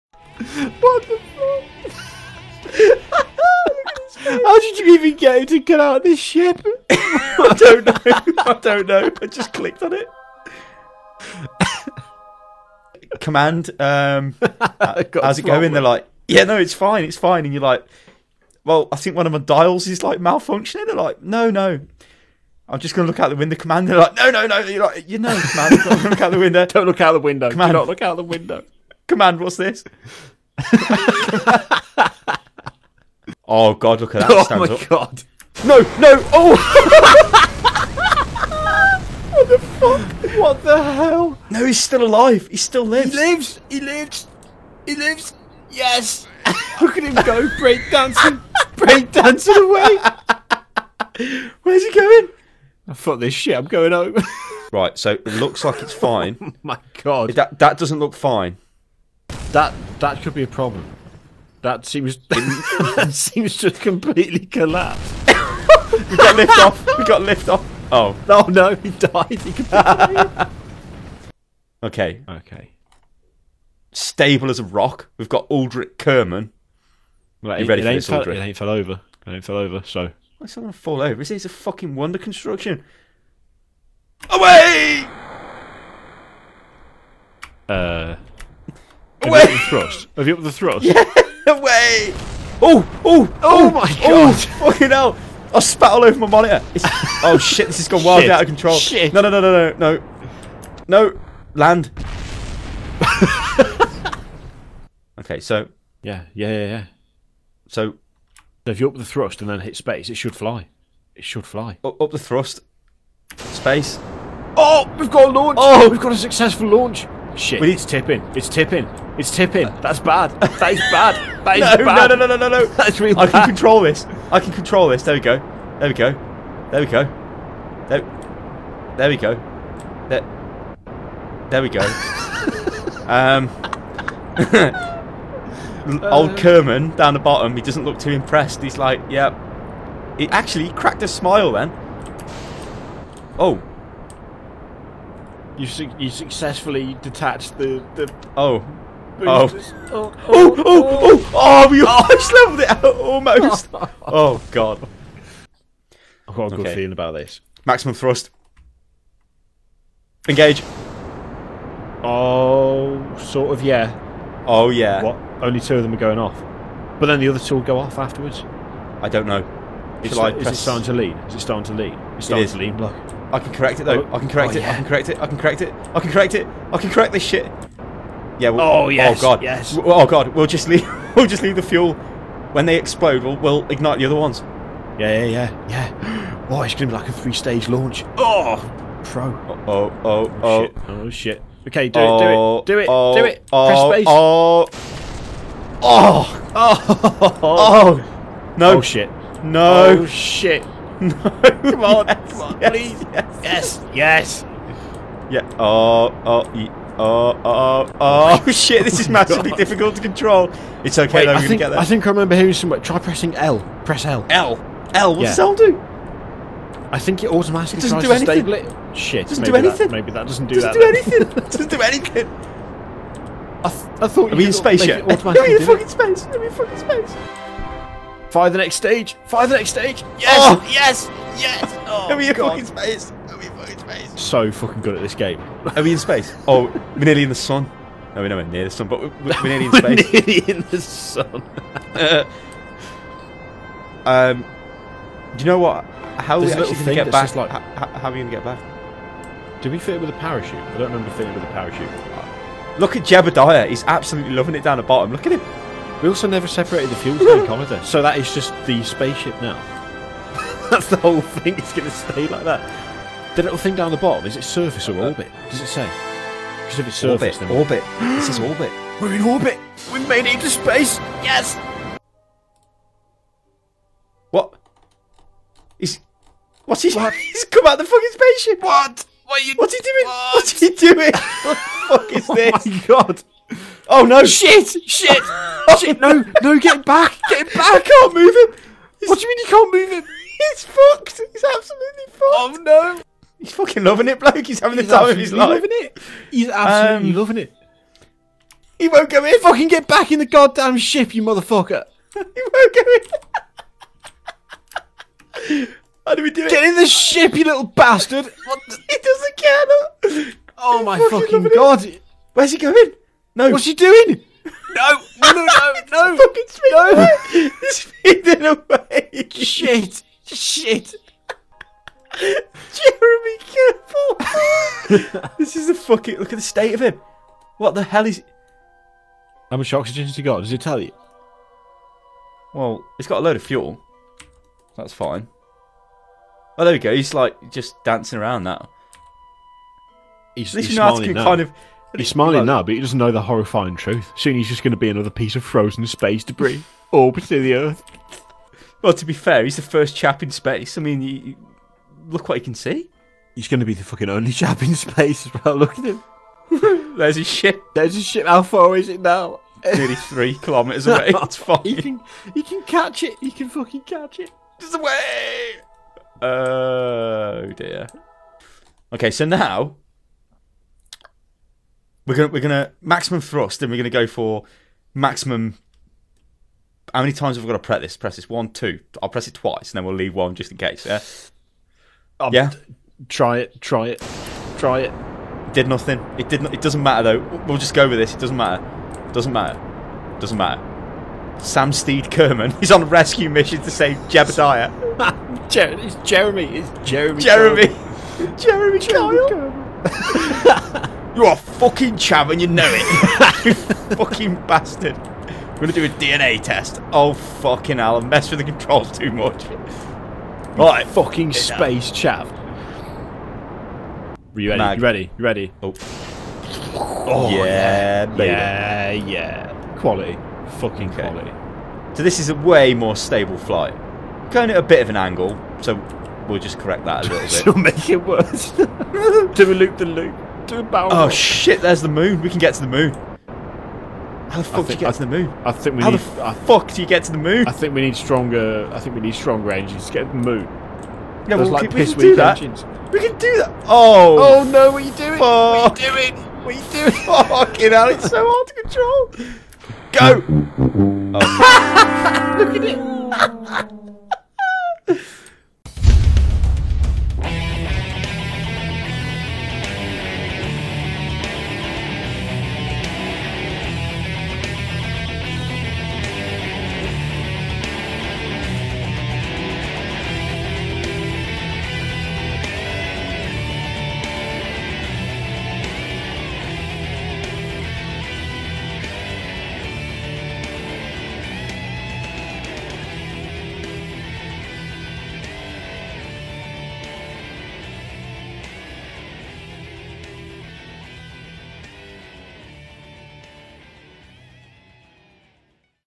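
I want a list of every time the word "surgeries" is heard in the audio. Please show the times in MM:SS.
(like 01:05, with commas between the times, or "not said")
not said.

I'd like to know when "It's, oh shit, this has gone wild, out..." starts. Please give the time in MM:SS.
01:36.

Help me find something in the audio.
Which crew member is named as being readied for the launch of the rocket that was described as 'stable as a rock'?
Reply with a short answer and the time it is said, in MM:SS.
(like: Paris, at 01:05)
Aldrich Kerman, at 01:15.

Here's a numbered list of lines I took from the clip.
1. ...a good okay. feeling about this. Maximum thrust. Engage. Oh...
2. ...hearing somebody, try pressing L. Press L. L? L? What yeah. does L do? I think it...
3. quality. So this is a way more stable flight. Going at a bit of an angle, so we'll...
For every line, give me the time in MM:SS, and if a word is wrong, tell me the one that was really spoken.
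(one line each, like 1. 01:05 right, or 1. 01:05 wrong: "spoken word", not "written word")
1. 02:36 right
2. 03:32 right
3. 07:01 right.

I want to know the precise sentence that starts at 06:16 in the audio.
How many times have we got to press this?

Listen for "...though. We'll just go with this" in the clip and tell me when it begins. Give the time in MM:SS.
06:27.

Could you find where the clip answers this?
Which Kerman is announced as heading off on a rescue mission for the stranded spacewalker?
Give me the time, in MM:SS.
06:31.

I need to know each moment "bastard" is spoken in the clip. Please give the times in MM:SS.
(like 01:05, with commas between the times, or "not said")
05:07, 06:44.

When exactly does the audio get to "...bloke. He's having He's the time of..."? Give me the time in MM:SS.
04:54.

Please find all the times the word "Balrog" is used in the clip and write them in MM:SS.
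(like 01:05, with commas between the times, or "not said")
07:10.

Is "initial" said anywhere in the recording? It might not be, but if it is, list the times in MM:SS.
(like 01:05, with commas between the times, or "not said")
not said.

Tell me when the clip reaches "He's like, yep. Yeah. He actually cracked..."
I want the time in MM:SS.
02:18.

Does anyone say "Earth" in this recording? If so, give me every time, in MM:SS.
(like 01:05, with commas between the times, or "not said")
05:47.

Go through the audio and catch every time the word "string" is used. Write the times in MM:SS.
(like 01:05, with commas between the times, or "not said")
not said.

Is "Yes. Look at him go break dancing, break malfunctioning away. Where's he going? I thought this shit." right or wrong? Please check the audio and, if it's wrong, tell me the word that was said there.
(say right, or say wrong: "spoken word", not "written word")
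wrong: "dancing", not "malfunctioning".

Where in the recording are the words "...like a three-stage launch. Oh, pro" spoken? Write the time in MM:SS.
03:06.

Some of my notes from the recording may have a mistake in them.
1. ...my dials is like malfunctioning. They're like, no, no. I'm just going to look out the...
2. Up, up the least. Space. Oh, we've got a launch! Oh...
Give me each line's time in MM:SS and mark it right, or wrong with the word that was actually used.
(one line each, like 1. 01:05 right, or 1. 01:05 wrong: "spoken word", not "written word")
1. 00:19 right
2. 01:51 wrong: "thrust", not "least".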